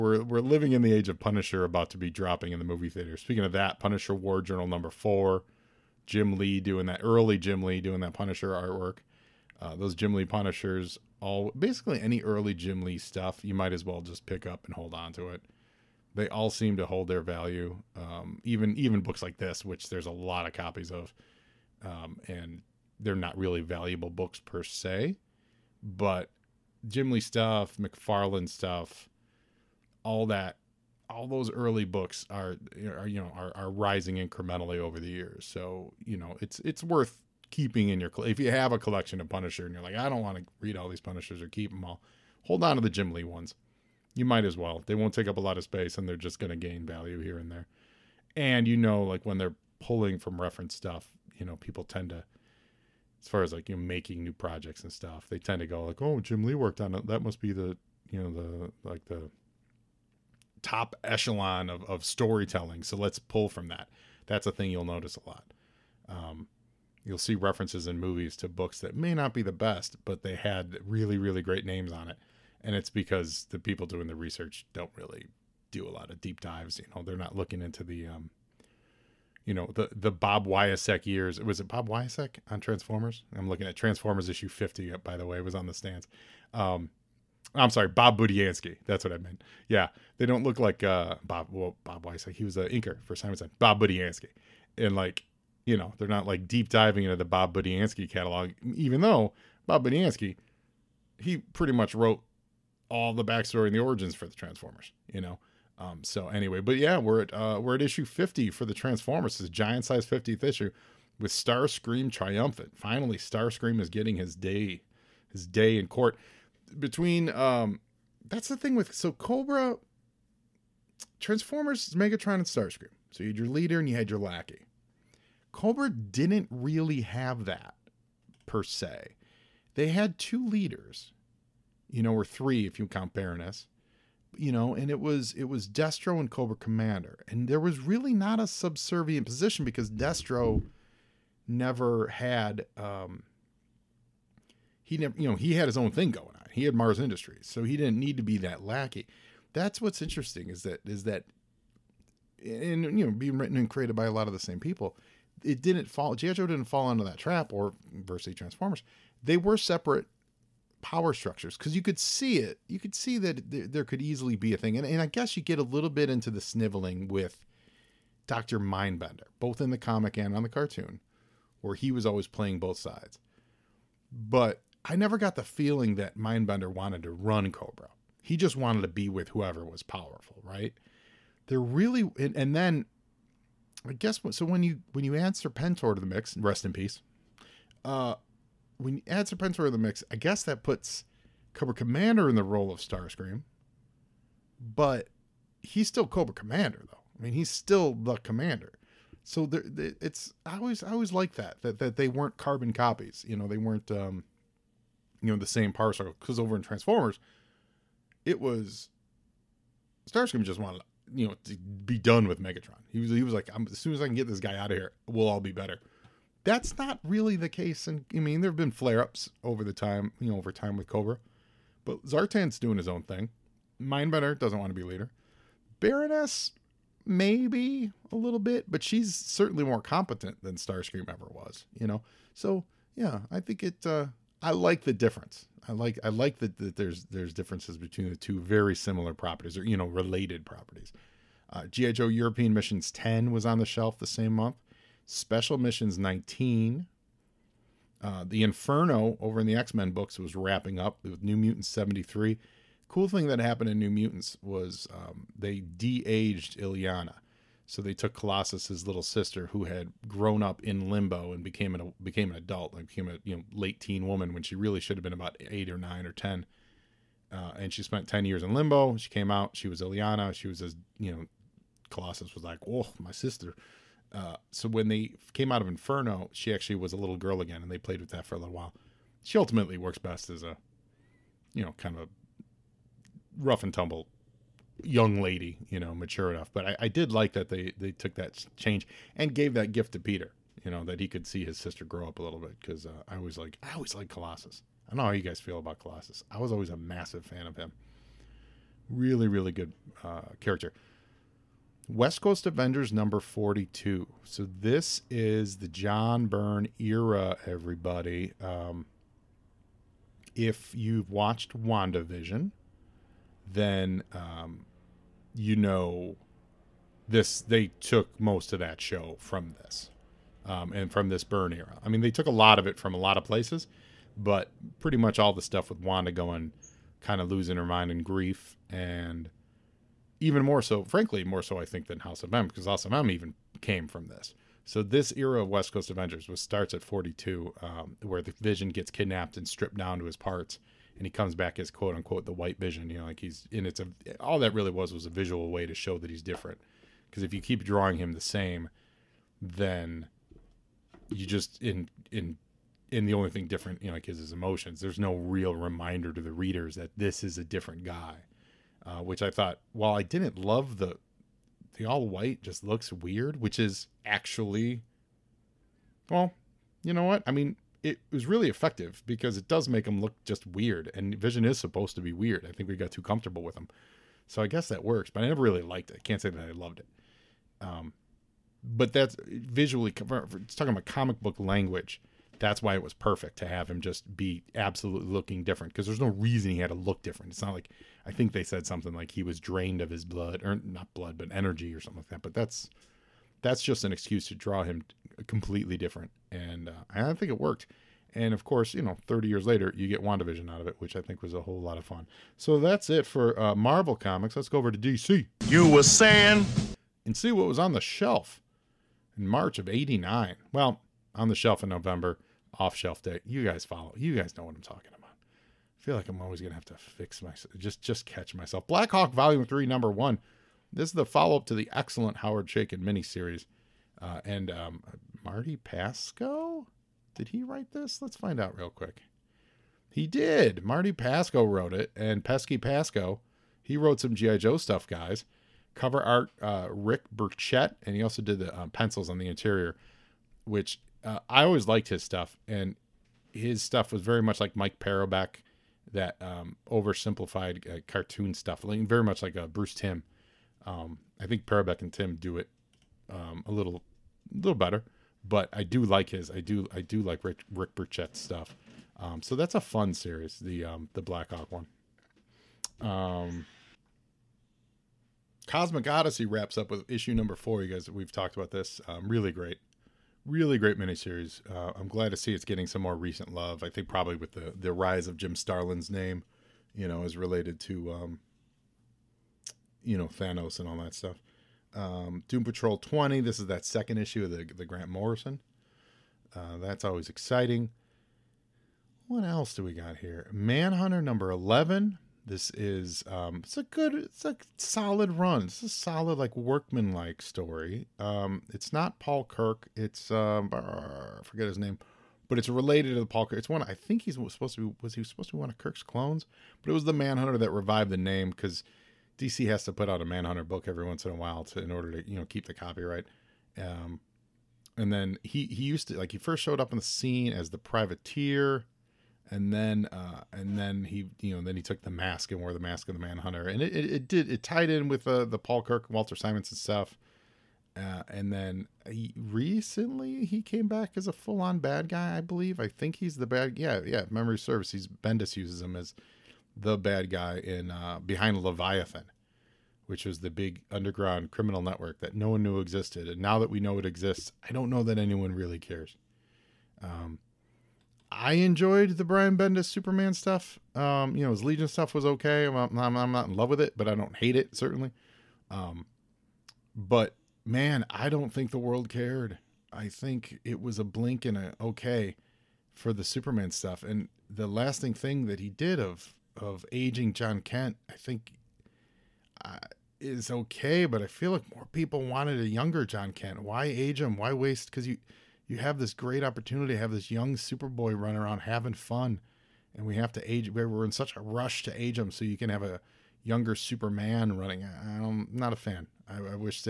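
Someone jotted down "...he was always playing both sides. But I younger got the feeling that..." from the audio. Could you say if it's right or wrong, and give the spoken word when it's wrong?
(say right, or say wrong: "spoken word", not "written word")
wrong: "never", not "younger".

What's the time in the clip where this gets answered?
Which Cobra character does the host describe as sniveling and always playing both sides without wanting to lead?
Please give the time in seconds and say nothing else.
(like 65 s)
168 s.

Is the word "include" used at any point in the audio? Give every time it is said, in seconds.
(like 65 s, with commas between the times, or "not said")
not said.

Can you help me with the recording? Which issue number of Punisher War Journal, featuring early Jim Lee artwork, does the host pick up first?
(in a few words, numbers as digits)
4.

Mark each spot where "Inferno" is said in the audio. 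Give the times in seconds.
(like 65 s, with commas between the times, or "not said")
248 s, 275 s.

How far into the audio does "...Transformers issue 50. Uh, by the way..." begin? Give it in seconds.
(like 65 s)
83 s.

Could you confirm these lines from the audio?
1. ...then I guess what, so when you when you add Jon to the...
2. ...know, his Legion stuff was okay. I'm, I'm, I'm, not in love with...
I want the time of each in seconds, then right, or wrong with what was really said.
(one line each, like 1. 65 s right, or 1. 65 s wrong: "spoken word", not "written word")
1. 182 s wrong: "Serpentor", not "Jon"
2. 551 s right.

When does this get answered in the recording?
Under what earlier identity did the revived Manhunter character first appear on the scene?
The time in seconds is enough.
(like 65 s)
517 s.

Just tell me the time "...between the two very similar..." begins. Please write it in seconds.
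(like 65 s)
237 s.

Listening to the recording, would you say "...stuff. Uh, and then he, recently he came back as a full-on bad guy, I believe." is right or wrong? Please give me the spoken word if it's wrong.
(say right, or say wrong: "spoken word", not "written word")
right.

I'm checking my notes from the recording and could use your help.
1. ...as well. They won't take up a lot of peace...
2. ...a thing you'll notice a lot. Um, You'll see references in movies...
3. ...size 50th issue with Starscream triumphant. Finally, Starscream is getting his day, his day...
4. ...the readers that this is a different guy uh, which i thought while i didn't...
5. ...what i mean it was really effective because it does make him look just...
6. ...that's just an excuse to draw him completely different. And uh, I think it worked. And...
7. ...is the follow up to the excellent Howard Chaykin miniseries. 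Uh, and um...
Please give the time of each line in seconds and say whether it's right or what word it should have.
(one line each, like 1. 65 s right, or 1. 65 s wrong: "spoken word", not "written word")
1. 44 s wrong: "space", not "peace"
2. 64 s right
3. 109 s right
4. 356 s right
5. 367 s right
6. 393 s right
7. 420 s right.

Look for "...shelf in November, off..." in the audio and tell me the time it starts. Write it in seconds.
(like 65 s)
411 s.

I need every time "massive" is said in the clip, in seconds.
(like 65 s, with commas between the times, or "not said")
296 s.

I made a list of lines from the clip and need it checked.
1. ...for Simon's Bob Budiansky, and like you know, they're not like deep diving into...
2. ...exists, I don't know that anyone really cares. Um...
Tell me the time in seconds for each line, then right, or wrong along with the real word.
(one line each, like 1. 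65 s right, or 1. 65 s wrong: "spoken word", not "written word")
1. 93 s right
2. 543 s right.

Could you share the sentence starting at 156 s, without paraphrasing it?
GI Joe didn't fall into that trap, or versus Transformers.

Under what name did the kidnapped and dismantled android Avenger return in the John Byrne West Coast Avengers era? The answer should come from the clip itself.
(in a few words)
The White Vision.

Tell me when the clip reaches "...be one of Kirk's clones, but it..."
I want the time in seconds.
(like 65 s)
505 s.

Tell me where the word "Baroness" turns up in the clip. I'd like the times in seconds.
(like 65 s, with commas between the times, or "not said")
133 s, 225 s.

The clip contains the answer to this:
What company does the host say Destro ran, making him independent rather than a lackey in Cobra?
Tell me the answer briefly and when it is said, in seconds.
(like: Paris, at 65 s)
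Mars Industries, at 146 s.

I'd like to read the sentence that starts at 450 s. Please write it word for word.
Um, I think Parobeck and Timm do it um, a little, little better.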